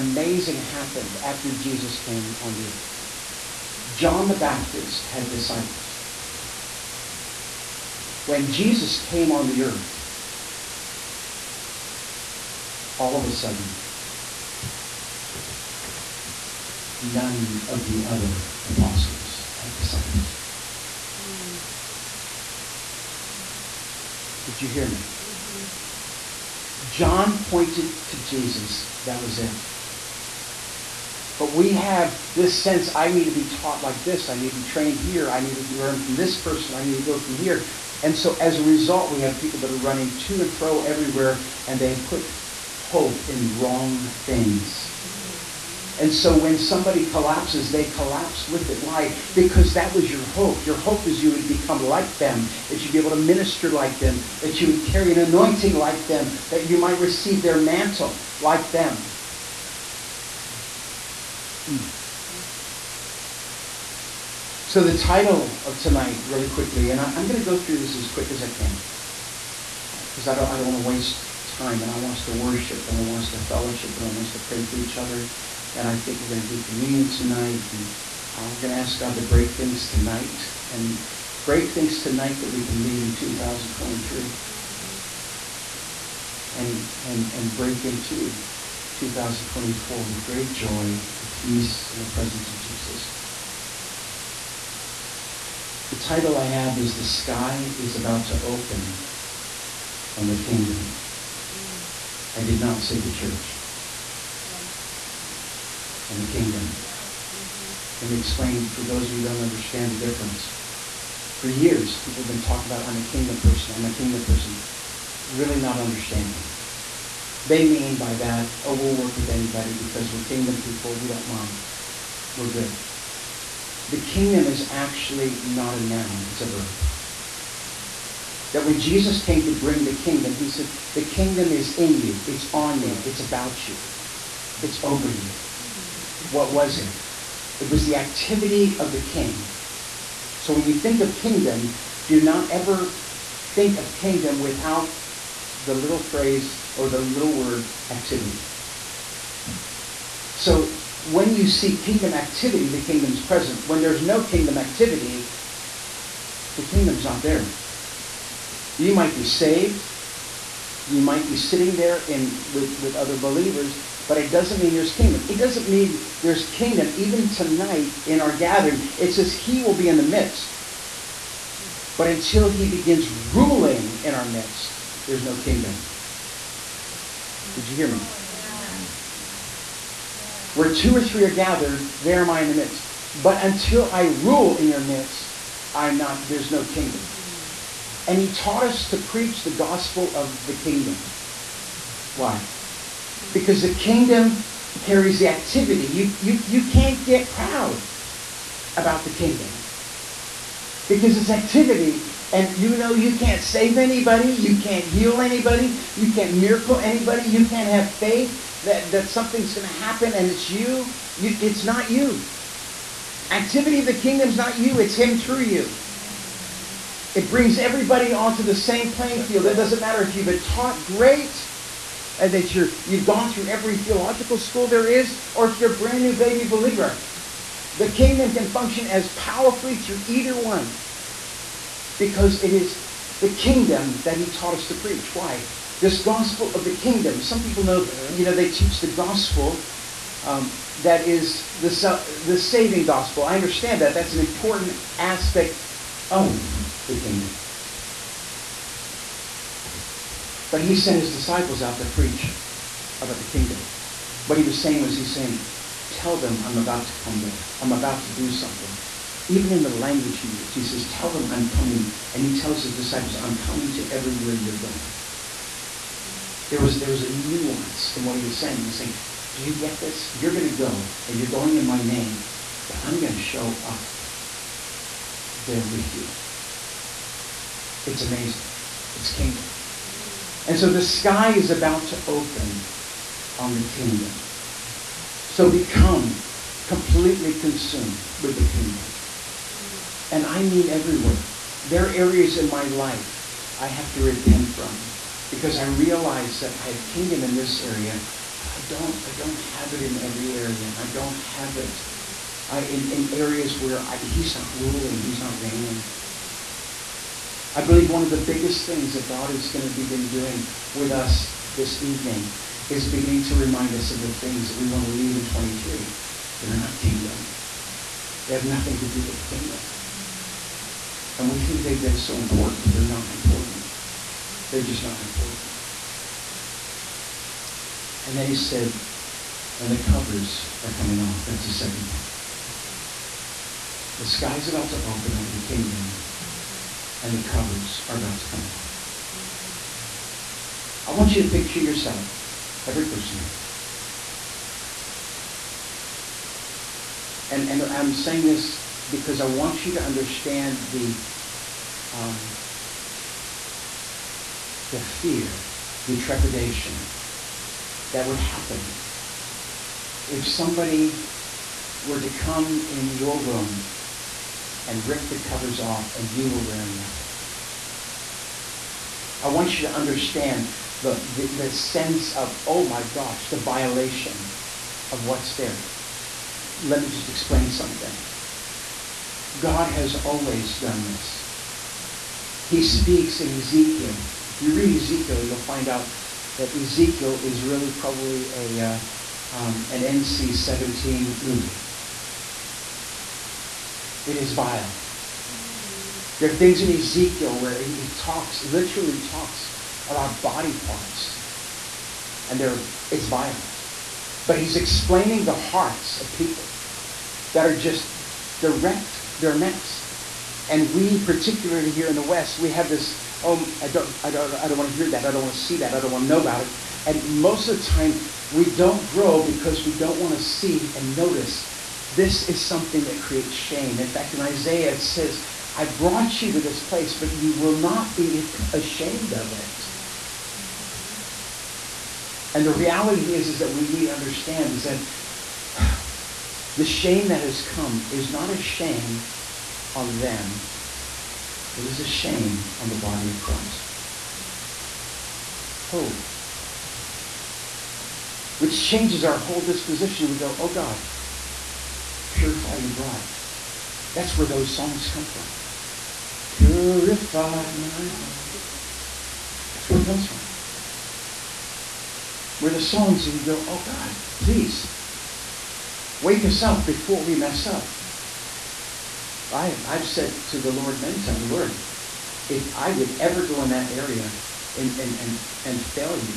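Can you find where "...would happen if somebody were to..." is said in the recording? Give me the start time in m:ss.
5:58.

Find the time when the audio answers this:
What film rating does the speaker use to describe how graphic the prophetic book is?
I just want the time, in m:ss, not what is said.
6:29.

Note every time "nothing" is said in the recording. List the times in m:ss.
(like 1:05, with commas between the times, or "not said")
5:18, 6:06.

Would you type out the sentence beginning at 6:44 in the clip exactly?
But he's explaining the hearts of people that are just direct their mess.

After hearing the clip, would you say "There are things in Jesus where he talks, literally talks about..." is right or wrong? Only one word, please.
wrong.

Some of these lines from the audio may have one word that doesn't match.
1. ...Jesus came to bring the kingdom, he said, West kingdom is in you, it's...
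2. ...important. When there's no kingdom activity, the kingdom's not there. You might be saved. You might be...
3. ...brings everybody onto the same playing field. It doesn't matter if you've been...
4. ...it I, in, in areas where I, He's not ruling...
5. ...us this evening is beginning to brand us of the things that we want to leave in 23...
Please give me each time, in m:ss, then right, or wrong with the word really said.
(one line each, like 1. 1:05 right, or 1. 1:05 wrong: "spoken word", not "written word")
1. 2:08 wrong: "The", not "West"
2. 2:33 wrong: "present", not "important"
3. 3:37 right
4. 5:01 right
5. 5:10 wrong: "remind", not "brand".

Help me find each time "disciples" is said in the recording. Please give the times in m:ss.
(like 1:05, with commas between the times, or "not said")
0:05, 0:19, 4:11, 4:22.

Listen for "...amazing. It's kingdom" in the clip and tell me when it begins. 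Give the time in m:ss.
4:38.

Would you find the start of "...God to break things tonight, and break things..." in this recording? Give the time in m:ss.
1:18.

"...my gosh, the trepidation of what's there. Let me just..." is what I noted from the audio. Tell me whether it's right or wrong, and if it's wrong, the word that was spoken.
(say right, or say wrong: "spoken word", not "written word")
wrong: "violation", not "trepidation".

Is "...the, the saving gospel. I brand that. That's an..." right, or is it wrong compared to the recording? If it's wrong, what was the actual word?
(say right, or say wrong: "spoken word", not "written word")
wrong: "understand", not "brand".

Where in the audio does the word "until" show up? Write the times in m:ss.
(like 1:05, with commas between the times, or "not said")
2:52, 3:03.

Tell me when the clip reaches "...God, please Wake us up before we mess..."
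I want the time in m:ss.
7:43.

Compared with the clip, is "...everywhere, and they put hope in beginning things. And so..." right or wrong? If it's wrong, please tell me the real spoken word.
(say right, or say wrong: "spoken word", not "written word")
wrong: "wrong", not "beginning".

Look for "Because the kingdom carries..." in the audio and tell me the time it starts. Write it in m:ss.
3:13.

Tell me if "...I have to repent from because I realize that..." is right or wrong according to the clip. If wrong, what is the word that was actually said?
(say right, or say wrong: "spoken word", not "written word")
right.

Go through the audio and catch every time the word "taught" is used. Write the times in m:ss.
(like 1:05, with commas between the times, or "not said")
0:33, 3:08, 3:40, 3:54.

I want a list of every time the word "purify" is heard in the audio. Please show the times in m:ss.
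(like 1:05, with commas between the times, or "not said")
7:32, 7:36.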